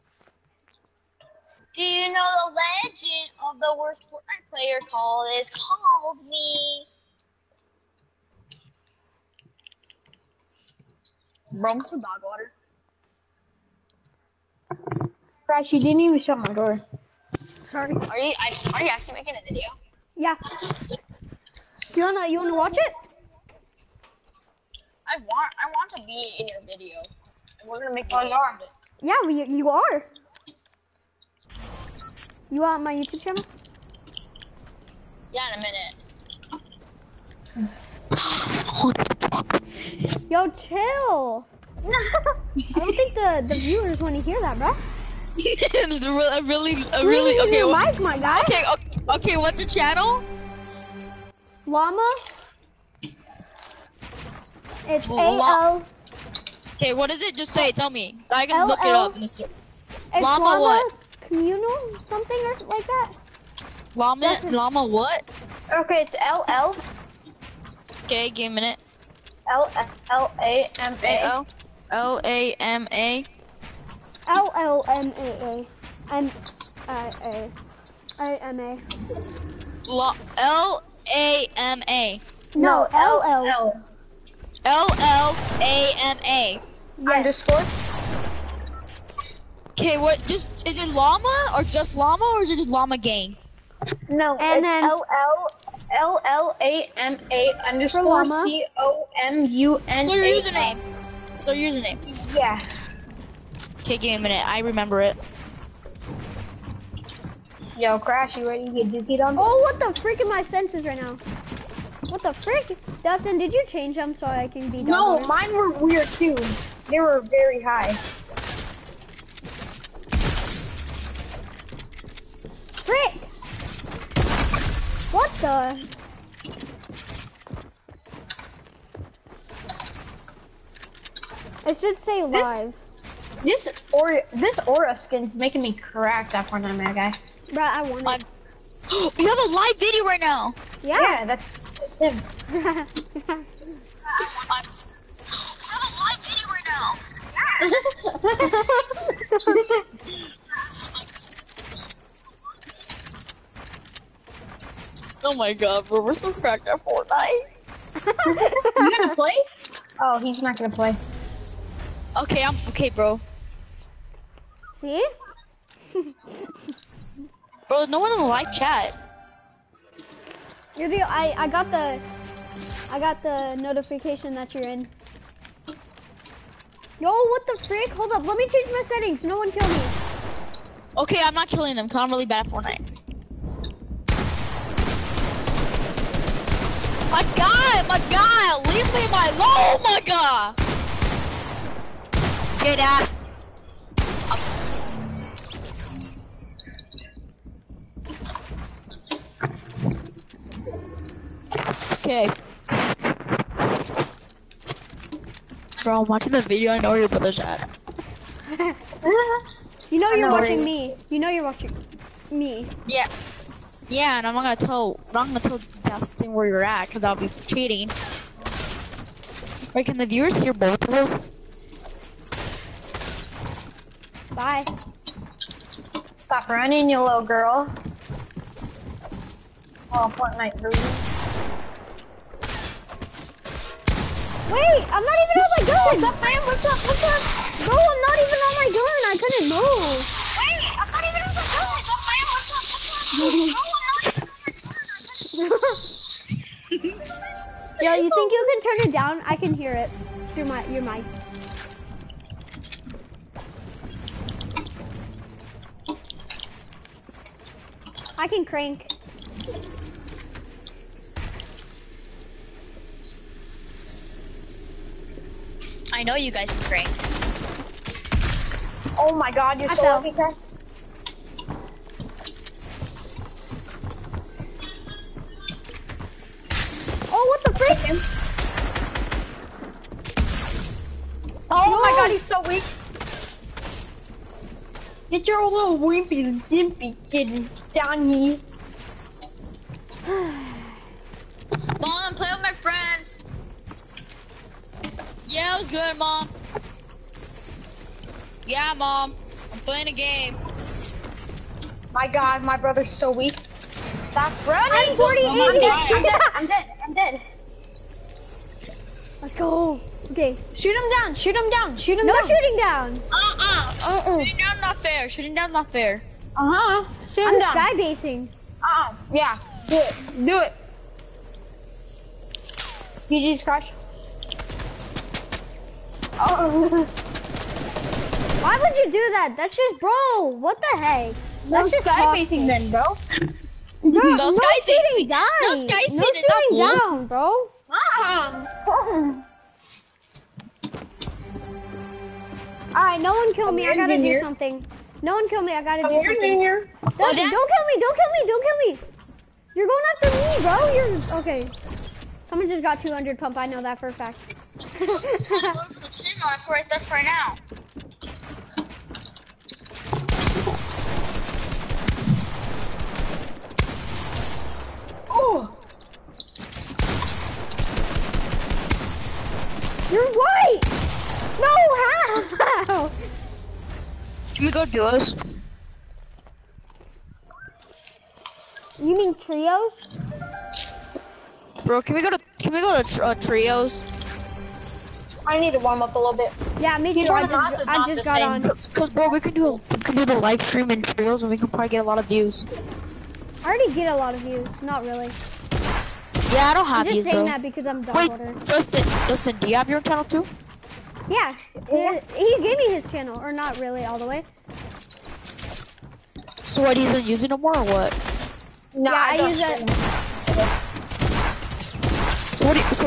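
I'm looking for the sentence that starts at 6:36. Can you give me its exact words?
Yeah, I don't have I'm just views.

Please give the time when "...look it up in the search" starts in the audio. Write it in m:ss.
0:58.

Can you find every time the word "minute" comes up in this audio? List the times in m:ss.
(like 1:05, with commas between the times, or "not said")
0:35, 1:08, 1:44.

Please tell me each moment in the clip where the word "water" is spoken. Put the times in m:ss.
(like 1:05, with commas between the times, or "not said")
0:12, 6:38.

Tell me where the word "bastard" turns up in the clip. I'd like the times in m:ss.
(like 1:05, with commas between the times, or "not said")
not said.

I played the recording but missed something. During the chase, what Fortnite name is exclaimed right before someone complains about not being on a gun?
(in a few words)
Fortnite Ruby.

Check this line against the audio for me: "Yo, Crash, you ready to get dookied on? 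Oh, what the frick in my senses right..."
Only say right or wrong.
right.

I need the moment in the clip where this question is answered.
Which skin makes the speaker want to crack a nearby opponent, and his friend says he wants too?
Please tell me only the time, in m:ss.
2:14.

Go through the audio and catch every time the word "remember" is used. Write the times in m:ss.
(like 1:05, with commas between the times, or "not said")
1:44.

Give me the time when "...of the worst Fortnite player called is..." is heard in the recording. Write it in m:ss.
0:03.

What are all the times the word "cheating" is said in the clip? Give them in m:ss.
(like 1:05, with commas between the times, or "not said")
3:37.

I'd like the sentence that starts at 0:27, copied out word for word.
And we're gonna make a video of it.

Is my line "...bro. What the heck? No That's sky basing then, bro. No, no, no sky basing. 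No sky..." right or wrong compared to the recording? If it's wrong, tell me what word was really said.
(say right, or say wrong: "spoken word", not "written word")
right.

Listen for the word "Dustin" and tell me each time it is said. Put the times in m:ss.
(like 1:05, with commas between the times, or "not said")
1:53, 3:35.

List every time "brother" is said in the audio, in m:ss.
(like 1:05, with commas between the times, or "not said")
3:27, 5:02.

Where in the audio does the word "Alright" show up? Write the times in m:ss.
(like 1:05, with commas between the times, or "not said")
5:42.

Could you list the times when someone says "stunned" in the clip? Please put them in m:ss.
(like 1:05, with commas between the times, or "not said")
not said.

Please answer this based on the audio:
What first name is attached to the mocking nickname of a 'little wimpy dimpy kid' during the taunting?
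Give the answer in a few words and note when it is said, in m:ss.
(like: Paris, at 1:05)
Johnny, at 4:47.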